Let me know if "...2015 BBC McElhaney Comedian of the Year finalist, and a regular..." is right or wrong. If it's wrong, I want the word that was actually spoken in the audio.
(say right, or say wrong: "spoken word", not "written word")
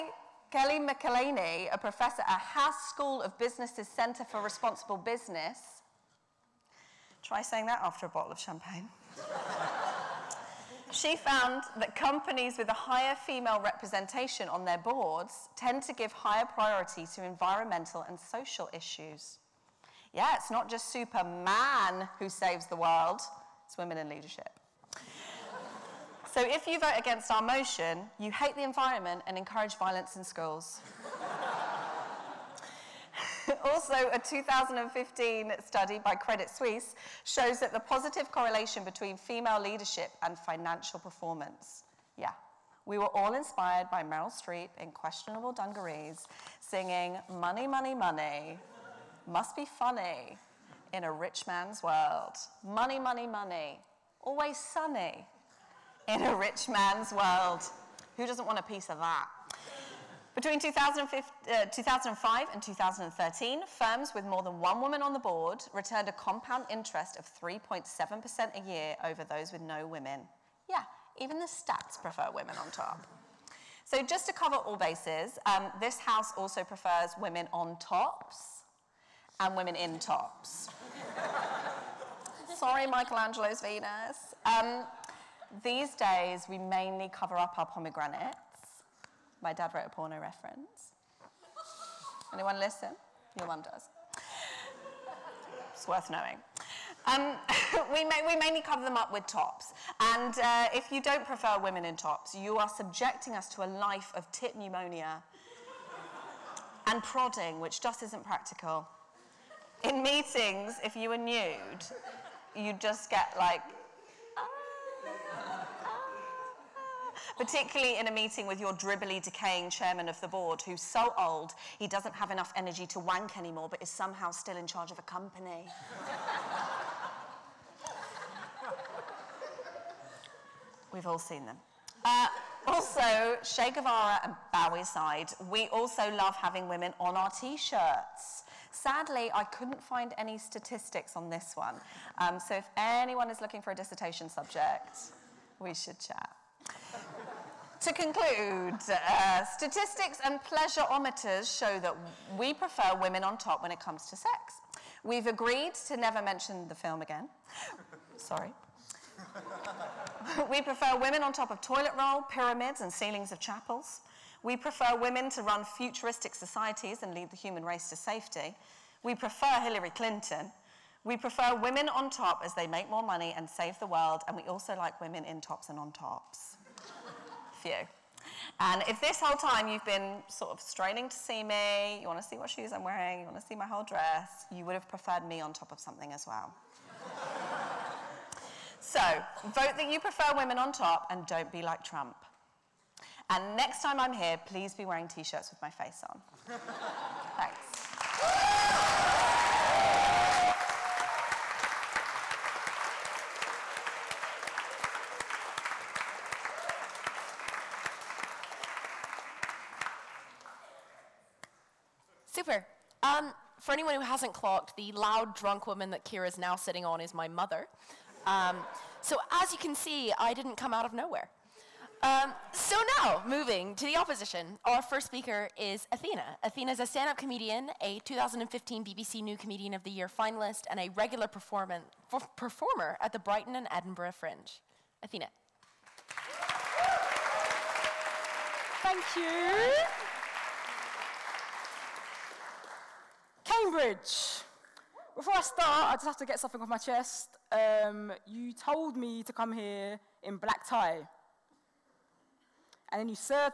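wrong: "New", not "McElhaney".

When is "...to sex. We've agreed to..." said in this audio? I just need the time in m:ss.
2:34.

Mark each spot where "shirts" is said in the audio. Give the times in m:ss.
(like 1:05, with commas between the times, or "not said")
2:17, 3:15.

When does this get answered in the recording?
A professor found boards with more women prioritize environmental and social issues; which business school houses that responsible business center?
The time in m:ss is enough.
0:02.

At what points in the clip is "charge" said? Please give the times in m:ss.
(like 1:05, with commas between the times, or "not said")
2:04.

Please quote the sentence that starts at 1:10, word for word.
Yeah, even the stats prefer women on top.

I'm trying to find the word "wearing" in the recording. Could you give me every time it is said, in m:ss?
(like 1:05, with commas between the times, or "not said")
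3:02, 3:14.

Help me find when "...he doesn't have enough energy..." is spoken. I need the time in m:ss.
2:01.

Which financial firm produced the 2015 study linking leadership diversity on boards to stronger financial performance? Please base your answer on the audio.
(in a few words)
Credit Suisse.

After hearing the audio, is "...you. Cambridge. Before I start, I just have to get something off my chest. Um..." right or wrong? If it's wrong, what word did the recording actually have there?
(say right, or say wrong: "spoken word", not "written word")
right.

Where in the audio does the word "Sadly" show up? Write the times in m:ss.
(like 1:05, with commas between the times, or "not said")
2:18.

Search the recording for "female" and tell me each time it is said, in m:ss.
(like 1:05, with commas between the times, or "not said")
0:13, 0:39.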